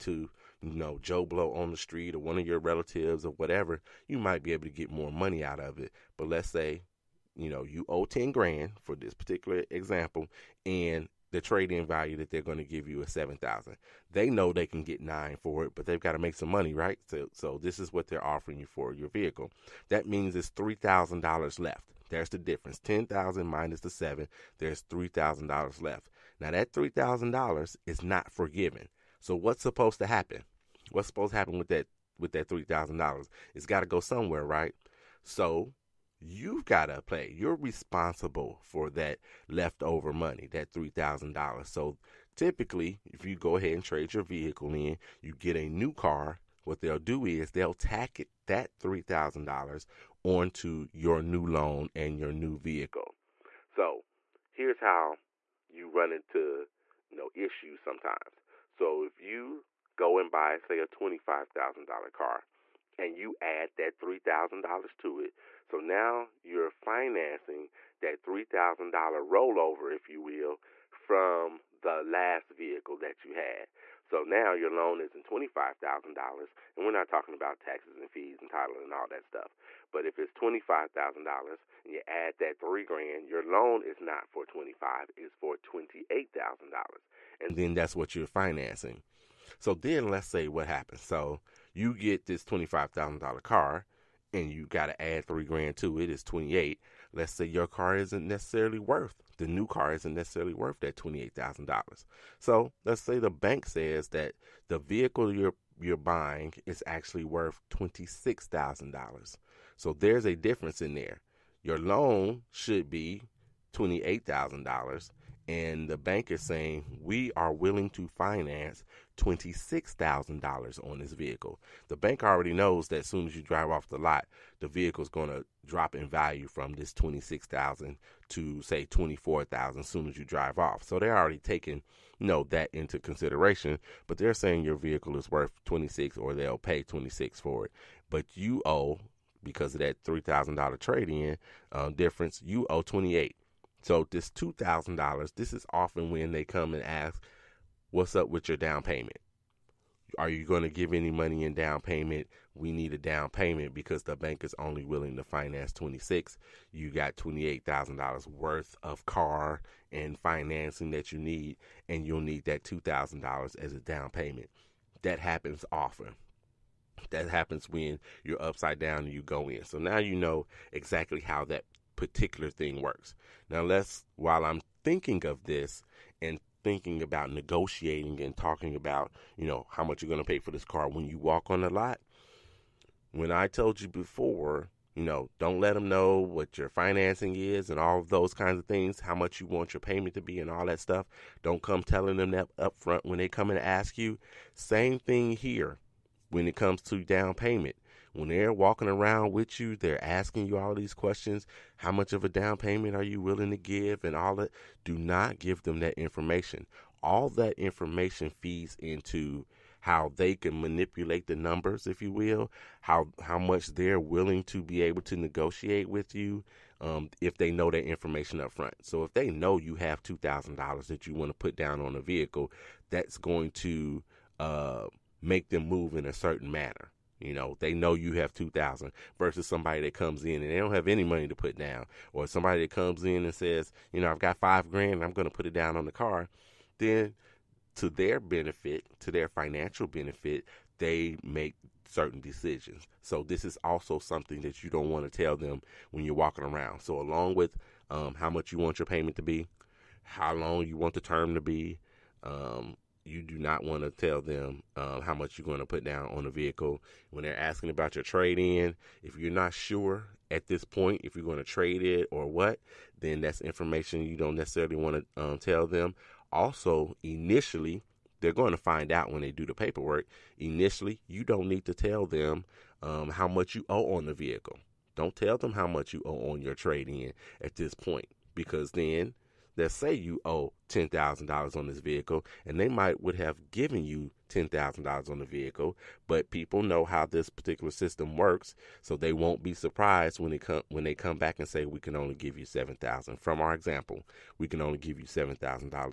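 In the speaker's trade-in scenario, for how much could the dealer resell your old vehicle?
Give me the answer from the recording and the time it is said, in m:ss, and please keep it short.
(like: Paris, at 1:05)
9, at 0:14.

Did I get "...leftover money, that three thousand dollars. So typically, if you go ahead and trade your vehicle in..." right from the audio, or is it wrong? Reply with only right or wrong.
right.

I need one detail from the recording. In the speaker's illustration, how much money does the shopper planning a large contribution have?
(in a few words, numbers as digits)
five grand.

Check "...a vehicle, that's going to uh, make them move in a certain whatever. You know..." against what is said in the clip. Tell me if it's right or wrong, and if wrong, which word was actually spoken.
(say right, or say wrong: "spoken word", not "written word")
wrong: "manner", not "whatever".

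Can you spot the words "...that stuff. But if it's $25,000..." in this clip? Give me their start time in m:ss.
1:19.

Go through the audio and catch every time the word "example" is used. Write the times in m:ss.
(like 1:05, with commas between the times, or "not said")
0:09, 4:53.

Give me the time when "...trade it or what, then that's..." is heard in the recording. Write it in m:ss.
4:21.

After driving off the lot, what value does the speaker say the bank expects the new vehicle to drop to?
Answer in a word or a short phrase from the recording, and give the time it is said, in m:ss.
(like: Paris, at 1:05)
24,000, at 2:08.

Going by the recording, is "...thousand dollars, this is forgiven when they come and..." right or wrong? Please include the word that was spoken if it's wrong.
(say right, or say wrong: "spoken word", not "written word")
wrong: "often", not "forgiven".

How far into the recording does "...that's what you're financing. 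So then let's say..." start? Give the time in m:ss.
1:27.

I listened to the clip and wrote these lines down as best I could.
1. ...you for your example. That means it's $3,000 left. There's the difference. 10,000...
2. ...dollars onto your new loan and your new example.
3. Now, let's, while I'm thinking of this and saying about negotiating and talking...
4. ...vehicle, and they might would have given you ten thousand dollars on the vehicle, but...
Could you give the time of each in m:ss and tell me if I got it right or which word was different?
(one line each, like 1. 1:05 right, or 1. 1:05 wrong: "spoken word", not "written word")
1. 0:18 wrong: "vehicle", not "example"
2. 0:49 wrong: "vehicle", not "example"
3. 2:53 wrong: "thinking", not "saying"
4. 4:41 right.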